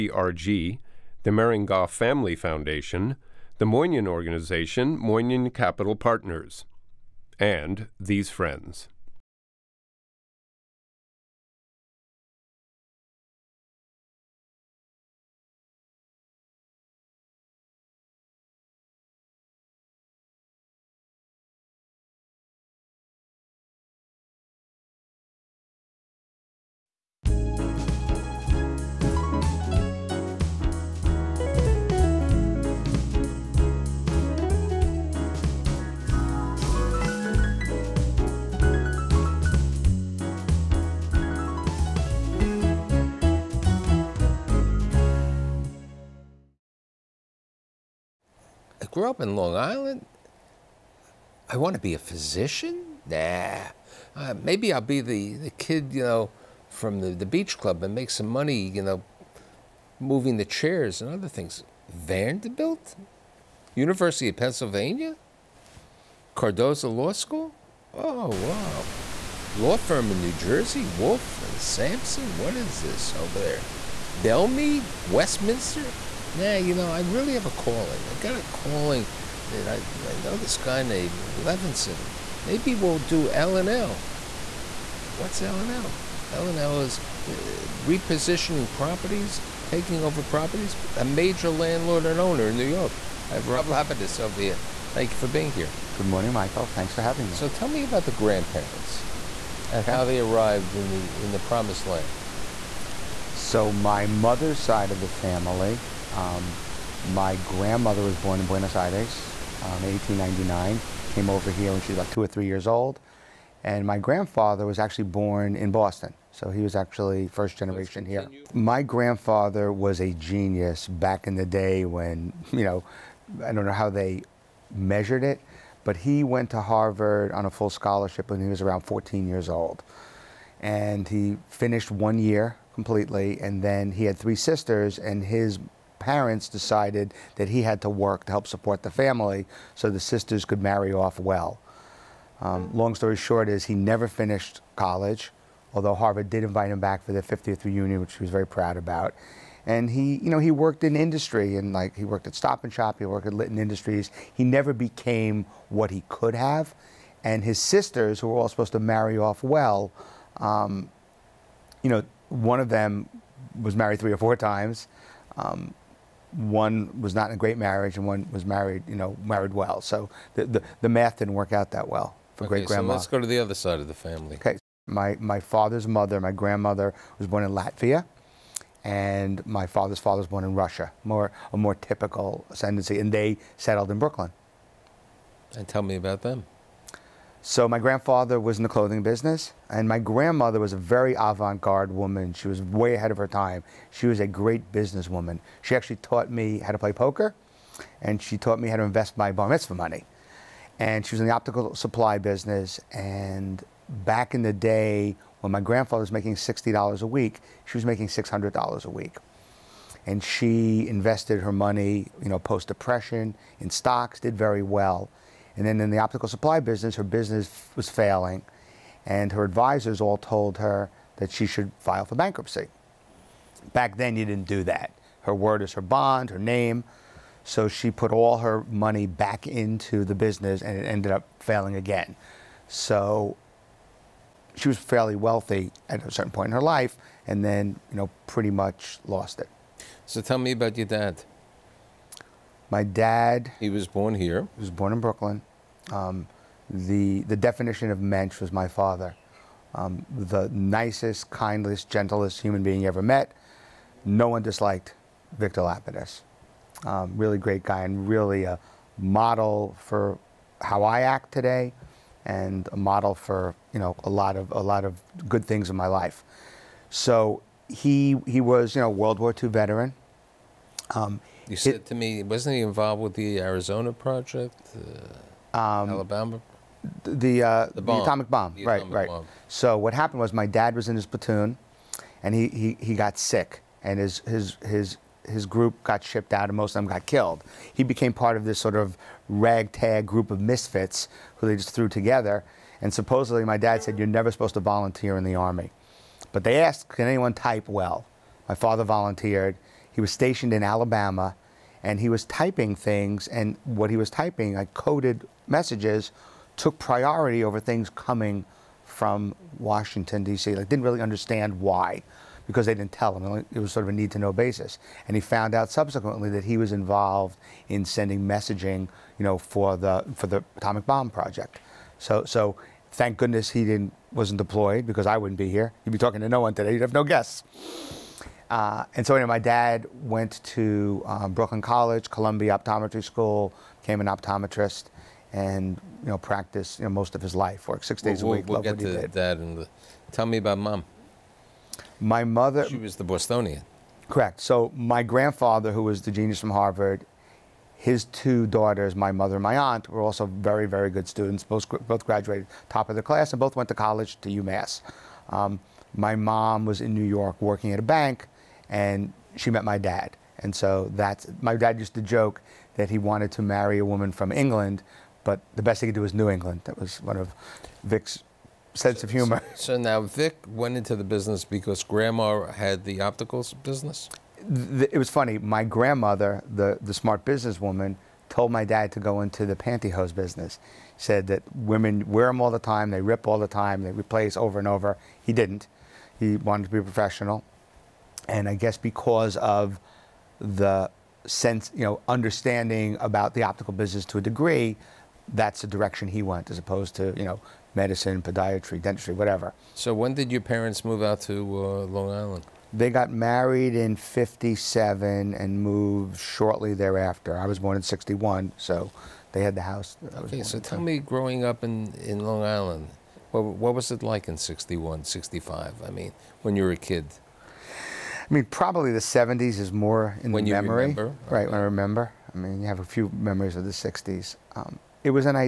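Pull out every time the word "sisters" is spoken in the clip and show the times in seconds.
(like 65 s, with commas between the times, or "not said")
134 s, 140 s, 157 s.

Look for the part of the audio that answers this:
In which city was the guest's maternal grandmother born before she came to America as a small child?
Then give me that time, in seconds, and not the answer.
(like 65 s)
108 s.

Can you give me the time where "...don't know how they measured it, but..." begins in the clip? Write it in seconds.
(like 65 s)
123 s.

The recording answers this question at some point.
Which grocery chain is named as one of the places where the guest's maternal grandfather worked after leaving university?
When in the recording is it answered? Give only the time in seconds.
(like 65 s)
152 s.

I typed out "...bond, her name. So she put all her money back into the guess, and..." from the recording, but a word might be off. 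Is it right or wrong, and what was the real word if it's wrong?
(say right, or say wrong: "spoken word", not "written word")
wrong: "business", not "guess".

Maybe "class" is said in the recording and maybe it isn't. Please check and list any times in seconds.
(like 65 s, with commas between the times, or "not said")
353 s.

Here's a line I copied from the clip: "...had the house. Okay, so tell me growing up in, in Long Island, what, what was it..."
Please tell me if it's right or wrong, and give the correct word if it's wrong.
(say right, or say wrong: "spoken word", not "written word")
right.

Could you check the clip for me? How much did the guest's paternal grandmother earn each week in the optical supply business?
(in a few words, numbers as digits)
$600.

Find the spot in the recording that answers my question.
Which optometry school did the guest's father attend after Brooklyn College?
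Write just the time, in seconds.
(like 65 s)
332 s.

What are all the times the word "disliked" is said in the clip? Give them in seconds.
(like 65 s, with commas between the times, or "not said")
254 s.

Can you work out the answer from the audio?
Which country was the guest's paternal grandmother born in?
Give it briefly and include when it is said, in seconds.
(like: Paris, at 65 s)
Latvia, at 177 s.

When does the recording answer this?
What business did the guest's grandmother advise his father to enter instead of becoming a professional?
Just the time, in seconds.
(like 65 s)
379 s.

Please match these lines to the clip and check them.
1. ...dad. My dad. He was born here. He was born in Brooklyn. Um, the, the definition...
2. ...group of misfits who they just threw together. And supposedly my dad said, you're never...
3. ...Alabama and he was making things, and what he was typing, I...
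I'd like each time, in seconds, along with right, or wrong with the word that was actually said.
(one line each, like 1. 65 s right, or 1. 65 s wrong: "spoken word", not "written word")
1. 240 s right
2. 290 s right
3. 300 s wrong: "typing", not "making".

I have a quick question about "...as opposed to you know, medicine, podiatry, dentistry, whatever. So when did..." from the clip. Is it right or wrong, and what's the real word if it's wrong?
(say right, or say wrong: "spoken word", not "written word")
right.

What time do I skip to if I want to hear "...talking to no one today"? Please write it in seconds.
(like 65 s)
325 s.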